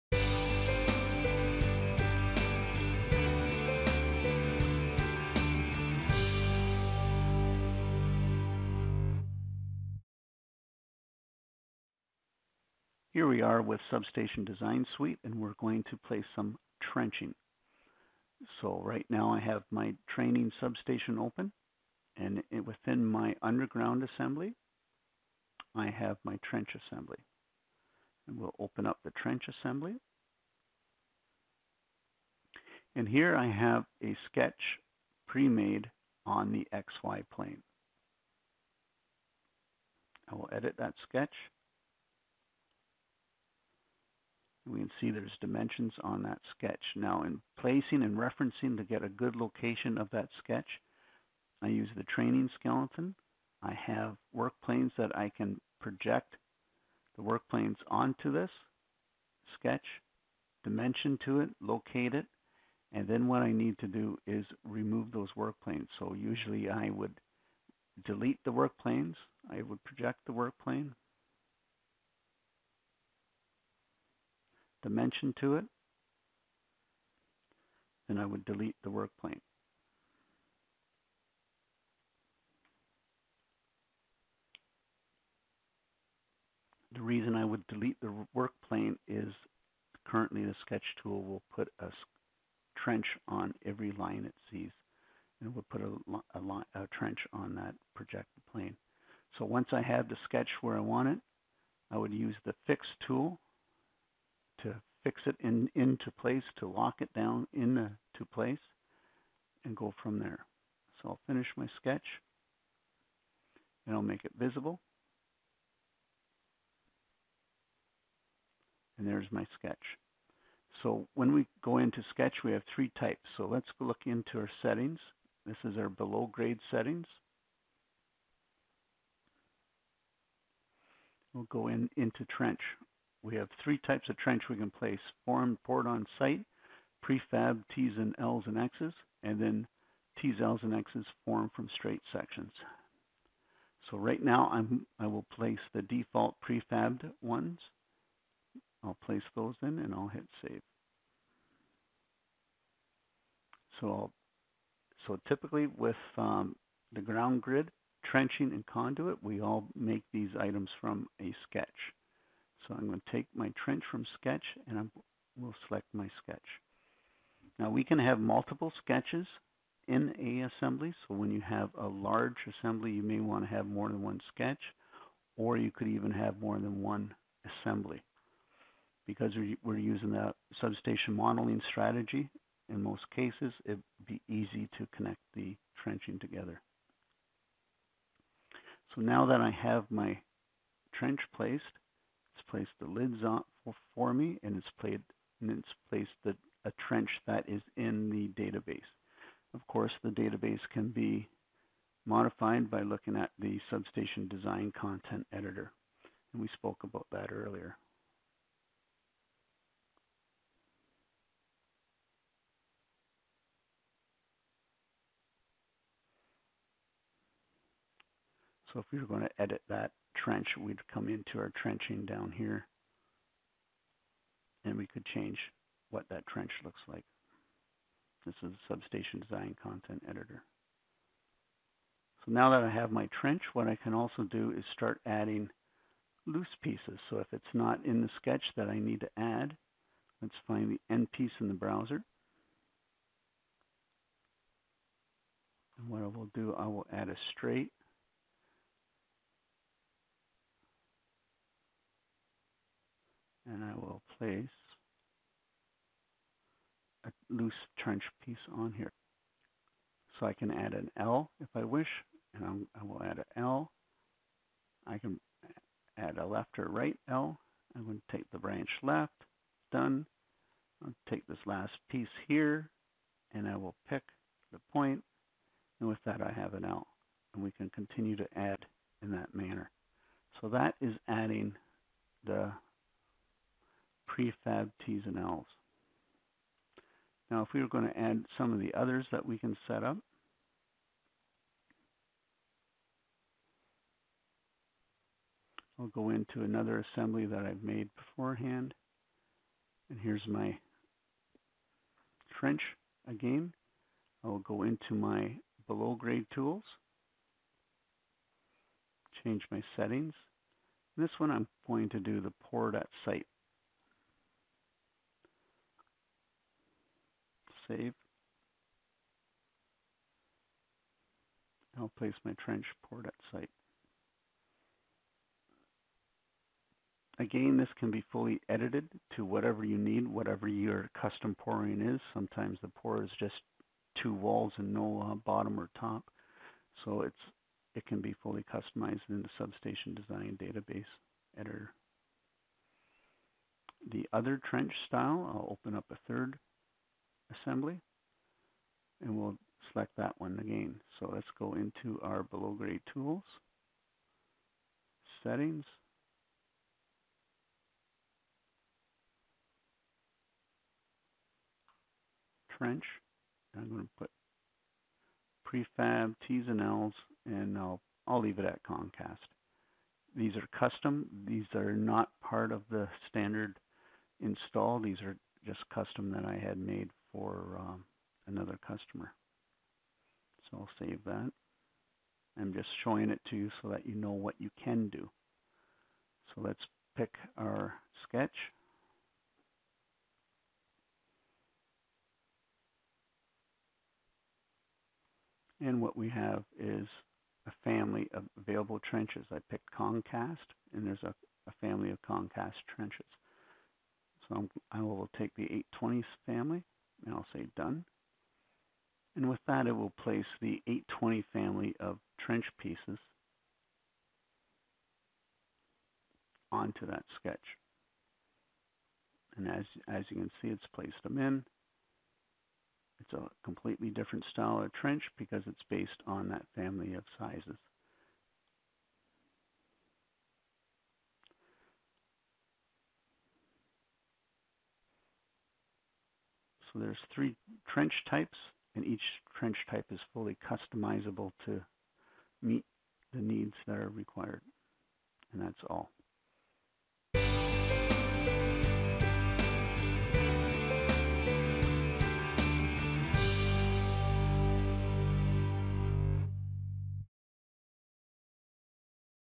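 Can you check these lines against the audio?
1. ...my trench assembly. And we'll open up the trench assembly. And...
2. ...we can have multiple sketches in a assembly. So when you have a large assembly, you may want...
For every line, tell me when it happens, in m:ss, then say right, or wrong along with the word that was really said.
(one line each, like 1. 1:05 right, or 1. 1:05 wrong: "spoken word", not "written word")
1. 0:26 right
2. 2:47 right.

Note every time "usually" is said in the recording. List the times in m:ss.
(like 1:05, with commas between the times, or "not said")
1:06.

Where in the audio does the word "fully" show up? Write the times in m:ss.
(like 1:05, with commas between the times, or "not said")
5:28, 5:38, 7:20.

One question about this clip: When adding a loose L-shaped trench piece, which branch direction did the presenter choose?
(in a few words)
Branch left.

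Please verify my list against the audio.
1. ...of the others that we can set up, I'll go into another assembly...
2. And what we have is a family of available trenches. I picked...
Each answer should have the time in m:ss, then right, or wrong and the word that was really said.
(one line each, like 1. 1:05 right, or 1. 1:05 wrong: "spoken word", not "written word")
1. 4:48 right
2. 6:35 right.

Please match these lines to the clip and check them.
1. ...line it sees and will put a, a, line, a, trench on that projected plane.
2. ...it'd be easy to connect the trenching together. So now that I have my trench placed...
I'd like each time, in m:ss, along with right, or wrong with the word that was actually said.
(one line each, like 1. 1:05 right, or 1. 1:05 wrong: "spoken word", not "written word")
1. 1:33 right
2. 3:03 right.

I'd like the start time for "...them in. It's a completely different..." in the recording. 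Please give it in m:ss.
7:01.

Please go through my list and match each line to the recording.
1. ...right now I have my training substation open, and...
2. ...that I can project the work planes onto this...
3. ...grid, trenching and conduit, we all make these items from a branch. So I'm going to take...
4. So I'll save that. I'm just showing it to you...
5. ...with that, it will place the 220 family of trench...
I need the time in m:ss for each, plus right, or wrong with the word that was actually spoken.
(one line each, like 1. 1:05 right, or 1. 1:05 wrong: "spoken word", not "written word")
1. 0:18 right
2. 0:54 right
3. 2:37 wrong: "sketch", not "branch"
4. 6:20 right
5. 6:49 wrong: "820", not "220".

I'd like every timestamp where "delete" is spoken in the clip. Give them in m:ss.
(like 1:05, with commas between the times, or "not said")
1:08, 1:18, 1:27.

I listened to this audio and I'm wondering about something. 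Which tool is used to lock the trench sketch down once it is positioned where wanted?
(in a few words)
Fix tool.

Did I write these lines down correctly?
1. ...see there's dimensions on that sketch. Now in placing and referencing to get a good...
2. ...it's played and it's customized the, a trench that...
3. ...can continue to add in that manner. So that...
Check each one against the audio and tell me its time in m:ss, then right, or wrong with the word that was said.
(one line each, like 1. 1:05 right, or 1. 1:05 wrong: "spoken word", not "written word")
1. 0:45 right
2. 3:14 wrong: "placed", not "customized"
3. 4:37 right.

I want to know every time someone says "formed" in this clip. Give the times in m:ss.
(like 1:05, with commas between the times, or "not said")
2:15, 2:21.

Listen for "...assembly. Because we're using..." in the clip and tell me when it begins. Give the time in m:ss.
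2:57.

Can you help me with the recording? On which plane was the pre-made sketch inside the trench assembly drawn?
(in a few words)
XY plane.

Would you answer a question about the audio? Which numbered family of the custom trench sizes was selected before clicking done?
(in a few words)
820s.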